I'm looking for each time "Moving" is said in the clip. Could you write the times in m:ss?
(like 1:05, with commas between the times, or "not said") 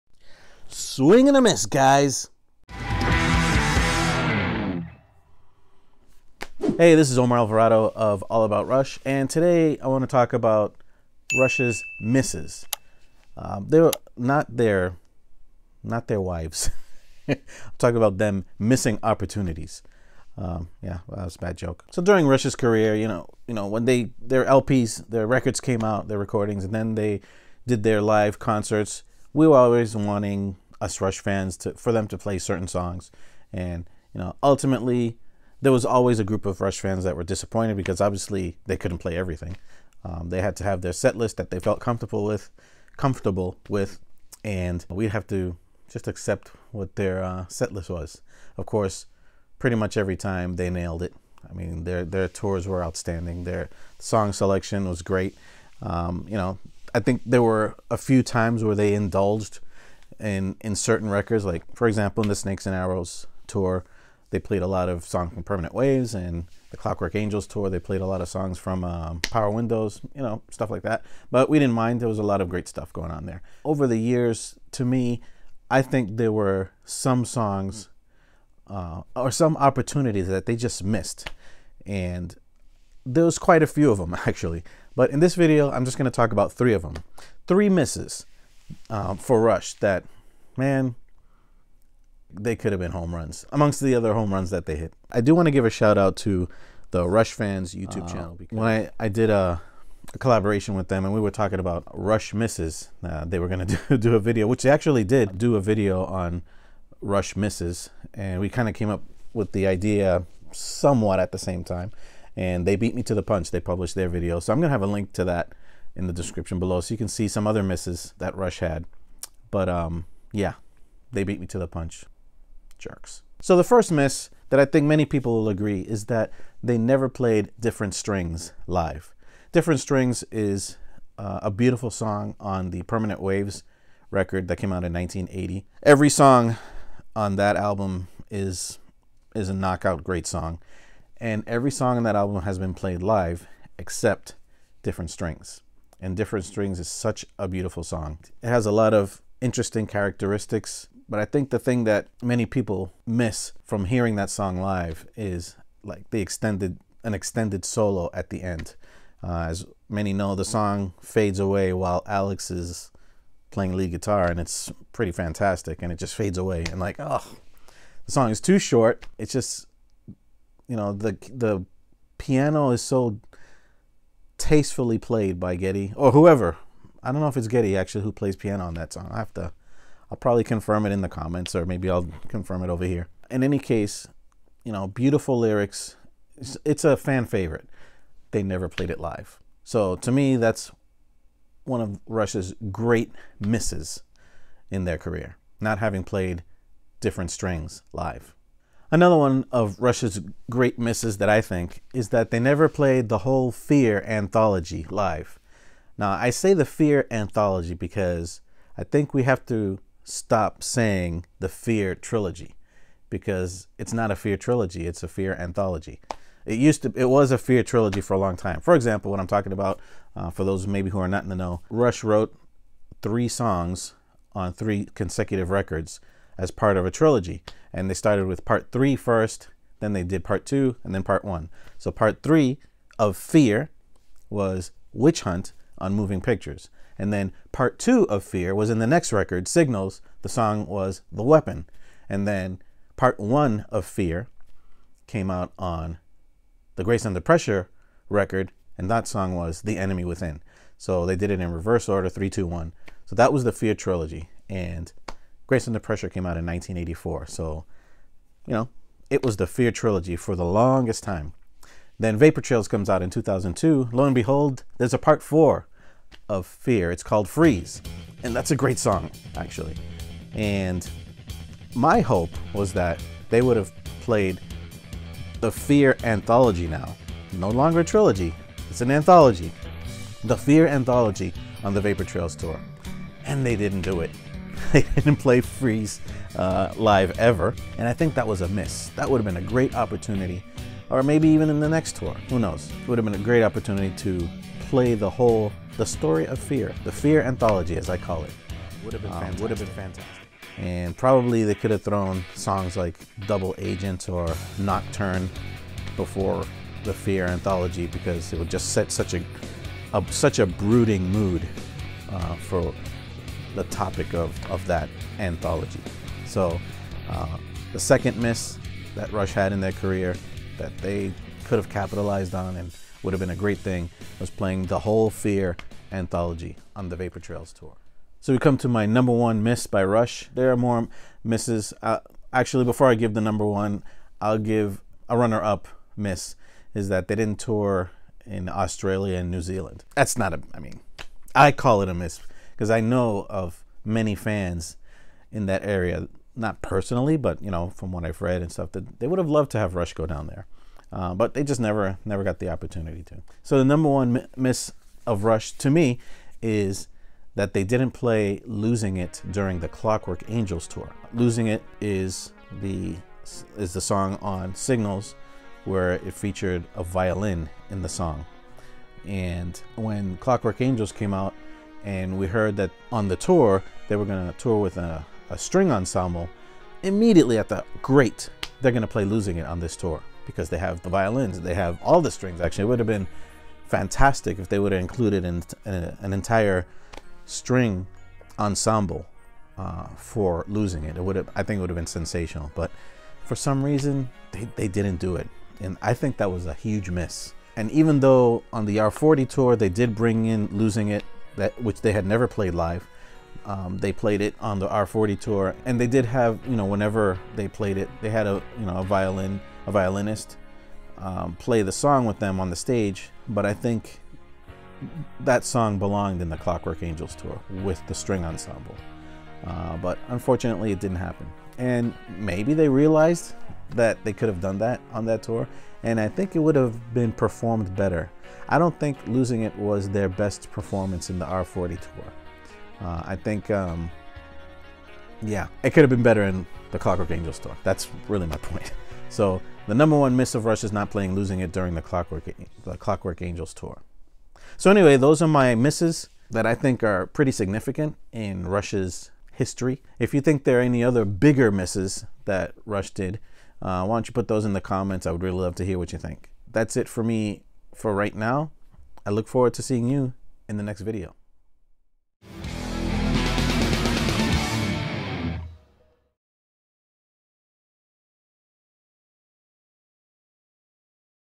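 3:55.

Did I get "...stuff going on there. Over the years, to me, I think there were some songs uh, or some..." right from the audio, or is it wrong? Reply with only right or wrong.
right.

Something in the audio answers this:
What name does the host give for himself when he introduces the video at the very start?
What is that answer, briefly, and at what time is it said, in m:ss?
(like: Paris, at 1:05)
Omar Alvarado, at 0:07.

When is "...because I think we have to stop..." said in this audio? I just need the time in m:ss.
3:27.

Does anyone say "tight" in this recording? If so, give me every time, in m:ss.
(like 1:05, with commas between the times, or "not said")
not said.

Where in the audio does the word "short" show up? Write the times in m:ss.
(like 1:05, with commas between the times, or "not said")
2:48.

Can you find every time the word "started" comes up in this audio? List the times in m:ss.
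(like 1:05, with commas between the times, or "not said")
3:47.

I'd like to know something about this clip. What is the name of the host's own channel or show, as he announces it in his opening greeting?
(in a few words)
All About Rush.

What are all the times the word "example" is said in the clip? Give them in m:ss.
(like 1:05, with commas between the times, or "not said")
1:01, 3:38.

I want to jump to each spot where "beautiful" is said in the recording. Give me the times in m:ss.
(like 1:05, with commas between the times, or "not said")
2:11, 2:27, 3:04.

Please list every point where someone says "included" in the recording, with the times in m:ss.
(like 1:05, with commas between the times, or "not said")
6:24.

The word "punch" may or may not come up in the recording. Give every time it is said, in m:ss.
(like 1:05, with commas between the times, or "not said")
1:53, 2:01.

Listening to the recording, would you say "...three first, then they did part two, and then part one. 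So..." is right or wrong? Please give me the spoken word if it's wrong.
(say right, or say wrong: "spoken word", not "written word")
right.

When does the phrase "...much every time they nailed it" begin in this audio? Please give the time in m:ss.
0:49.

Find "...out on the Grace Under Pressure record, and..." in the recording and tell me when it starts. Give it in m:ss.
4:05.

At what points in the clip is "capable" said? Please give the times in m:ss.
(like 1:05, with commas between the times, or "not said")
not said.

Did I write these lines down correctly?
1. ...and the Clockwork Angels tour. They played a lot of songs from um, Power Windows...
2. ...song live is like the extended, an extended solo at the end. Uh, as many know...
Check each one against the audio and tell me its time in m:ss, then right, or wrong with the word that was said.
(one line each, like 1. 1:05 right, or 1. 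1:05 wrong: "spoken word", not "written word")
1. 1:06 right
2. 2:34 right.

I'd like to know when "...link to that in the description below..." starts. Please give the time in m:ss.
1:54.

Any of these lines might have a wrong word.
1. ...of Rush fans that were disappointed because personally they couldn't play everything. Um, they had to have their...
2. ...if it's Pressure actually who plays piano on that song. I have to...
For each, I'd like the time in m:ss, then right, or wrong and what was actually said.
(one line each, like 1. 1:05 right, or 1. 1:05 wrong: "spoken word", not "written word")
1. 0:36 wrong: "obviously", not "personally"
2. 2:57 wrong: "Geddy", not "Pressure".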